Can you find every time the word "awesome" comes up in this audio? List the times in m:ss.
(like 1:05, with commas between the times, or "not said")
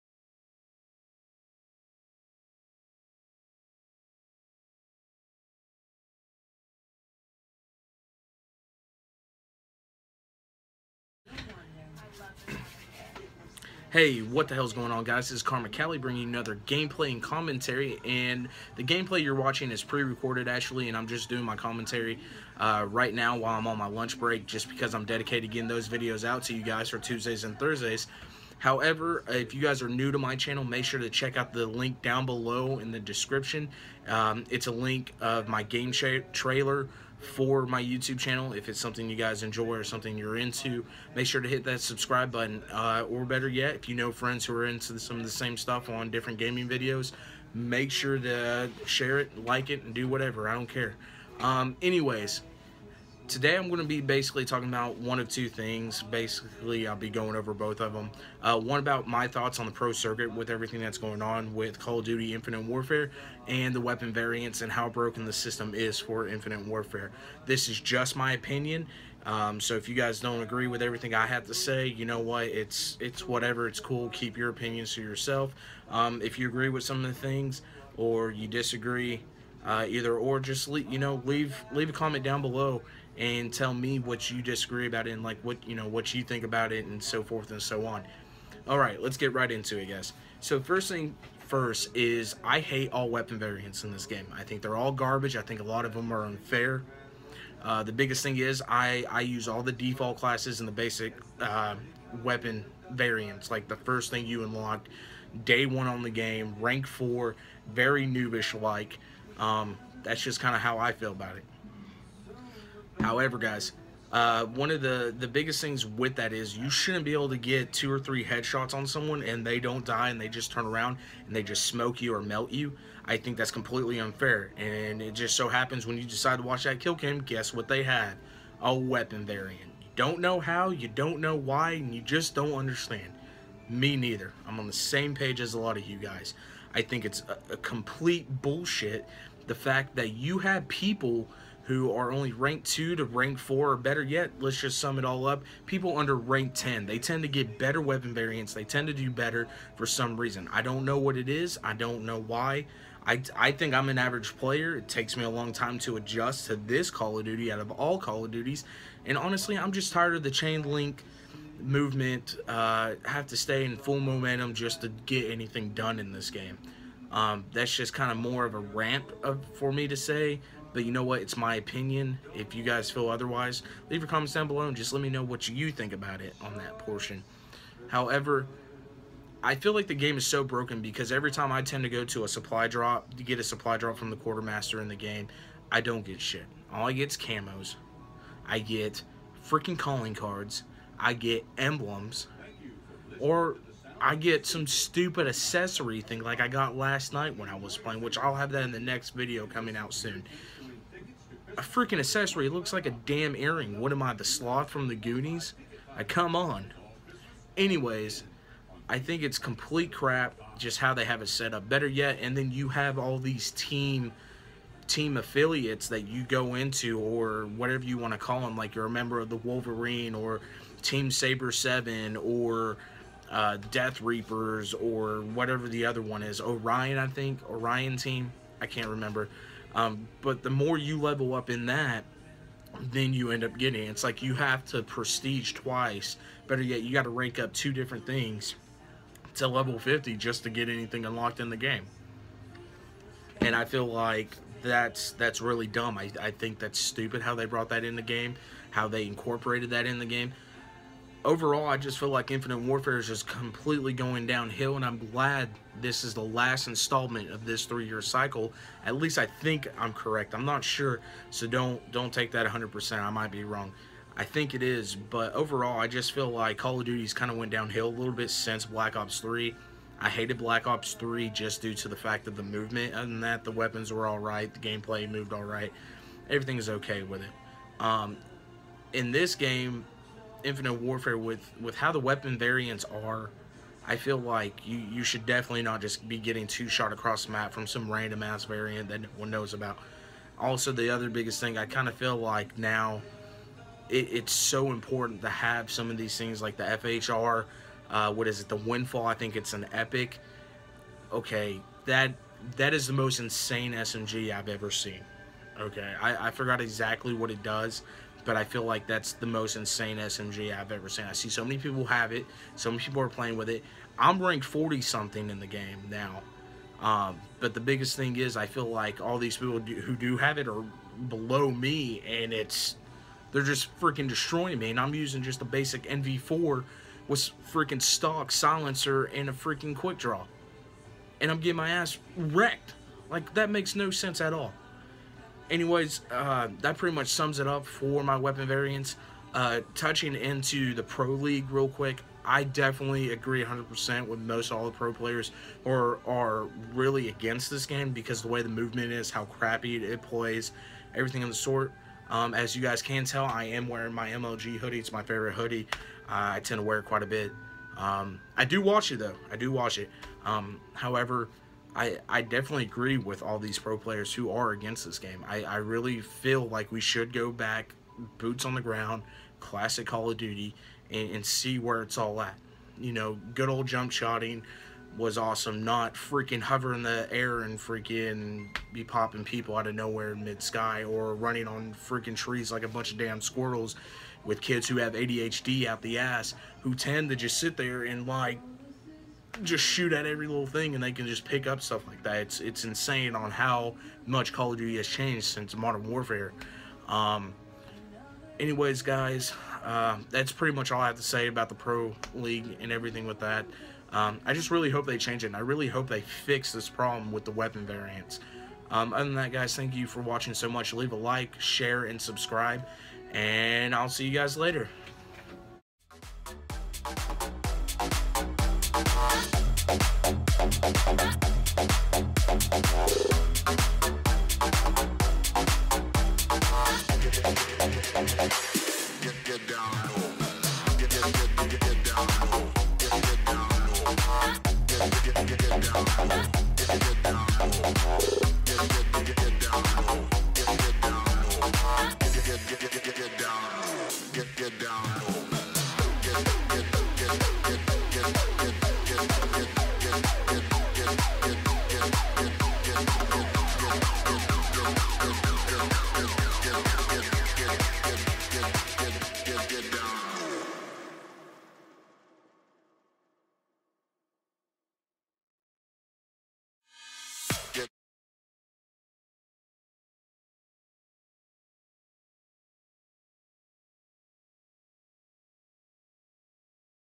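6:15.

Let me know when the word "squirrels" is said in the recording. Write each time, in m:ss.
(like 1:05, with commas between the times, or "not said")
6:23.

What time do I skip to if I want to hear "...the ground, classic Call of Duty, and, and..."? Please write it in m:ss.
6:08.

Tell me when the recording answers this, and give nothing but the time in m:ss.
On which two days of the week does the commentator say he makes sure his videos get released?
0:26.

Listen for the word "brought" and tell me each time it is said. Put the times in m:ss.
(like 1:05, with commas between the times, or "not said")
4:07.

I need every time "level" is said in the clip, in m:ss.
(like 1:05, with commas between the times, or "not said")
3:50, 3:59.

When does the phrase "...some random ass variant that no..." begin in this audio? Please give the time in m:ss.
4:47.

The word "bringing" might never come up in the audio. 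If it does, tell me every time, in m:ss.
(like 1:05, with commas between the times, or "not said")
0:15.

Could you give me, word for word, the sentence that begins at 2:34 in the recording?
It takes me a long time to adjust to this Call of Duty out of all Call of Duties.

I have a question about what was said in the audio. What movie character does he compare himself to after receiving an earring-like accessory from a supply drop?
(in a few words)
Sloth from the Goonies.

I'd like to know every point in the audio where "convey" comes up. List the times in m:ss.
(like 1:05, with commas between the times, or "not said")
not said.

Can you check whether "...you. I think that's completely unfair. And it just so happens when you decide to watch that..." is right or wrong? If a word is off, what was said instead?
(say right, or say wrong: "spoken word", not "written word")
right.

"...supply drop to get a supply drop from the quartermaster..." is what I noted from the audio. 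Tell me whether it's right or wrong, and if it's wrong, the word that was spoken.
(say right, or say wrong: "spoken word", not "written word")
right.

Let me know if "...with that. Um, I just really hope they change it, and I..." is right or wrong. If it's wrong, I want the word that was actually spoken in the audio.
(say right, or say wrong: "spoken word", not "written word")
right.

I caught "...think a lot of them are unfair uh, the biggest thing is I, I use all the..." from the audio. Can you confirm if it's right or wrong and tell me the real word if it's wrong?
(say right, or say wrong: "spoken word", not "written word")
right.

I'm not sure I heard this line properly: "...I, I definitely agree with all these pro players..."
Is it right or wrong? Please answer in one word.
right.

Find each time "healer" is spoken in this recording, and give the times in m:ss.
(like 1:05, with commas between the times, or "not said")
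not said.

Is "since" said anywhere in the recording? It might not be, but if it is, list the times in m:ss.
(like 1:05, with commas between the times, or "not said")
4:28, 6:35.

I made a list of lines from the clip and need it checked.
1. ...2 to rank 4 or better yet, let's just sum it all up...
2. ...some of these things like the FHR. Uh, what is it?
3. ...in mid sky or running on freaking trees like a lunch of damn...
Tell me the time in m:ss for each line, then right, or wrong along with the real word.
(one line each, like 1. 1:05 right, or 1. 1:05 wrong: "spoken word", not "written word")
1. 2:22 right
2. 4:55 right
3. 6:20 wrong: "bunch", not "lunch".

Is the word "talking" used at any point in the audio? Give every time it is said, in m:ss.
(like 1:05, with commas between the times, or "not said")
0:54.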